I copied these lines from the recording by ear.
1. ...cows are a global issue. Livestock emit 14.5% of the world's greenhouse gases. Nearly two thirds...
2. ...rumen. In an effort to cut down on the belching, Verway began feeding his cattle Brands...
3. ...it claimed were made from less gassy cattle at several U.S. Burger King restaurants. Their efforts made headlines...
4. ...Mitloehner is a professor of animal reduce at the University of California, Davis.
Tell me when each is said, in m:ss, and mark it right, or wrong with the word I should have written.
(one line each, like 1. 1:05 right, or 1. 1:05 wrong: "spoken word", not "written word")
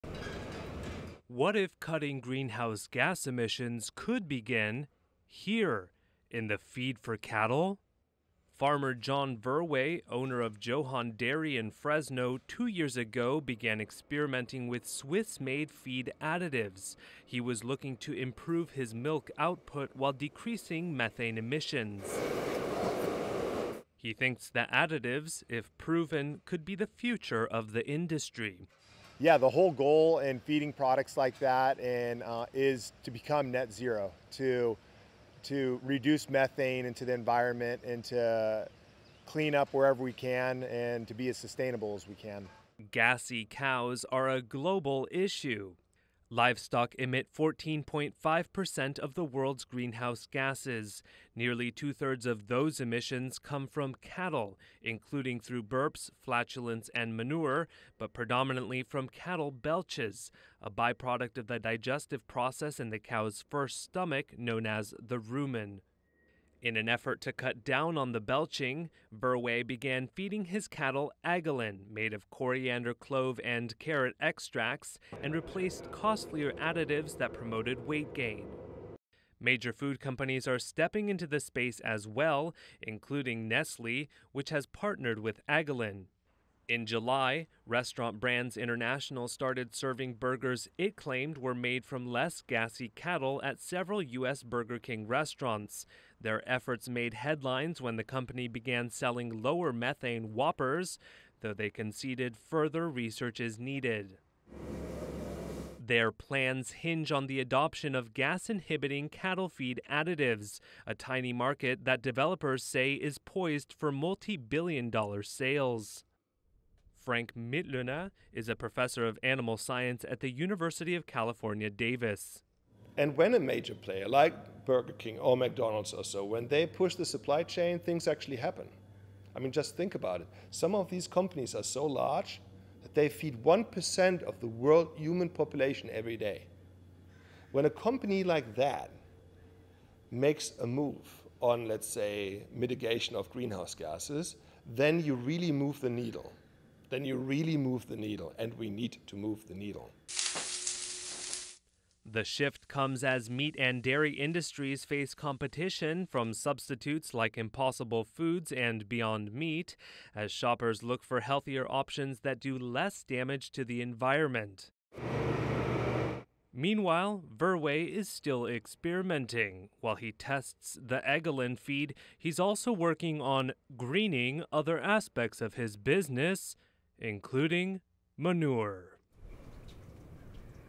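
1. 0:43 right
2. 1:05 wrong: "Agolin", not "Brands"
3. 1:30 right
4. 1:57 wrong: "science", not "reduce".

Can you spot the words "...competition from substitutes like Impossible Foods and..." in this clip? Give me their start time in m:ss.
2:35.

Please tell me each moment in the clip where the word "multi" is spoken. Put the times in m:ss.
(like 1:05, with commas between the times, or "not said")
1:53.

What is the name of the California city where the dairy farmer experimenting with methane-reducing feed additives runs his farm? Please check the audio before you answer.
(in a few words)
Fresno.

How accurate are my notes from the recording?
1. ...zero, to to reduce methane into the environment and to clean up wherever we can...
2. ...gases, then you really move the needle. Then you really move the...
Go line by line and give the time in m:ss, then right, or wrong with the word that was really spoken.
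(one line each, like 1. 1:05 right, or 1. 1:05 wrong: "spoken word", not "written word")
1. 0:33 right
2. 2:23 right.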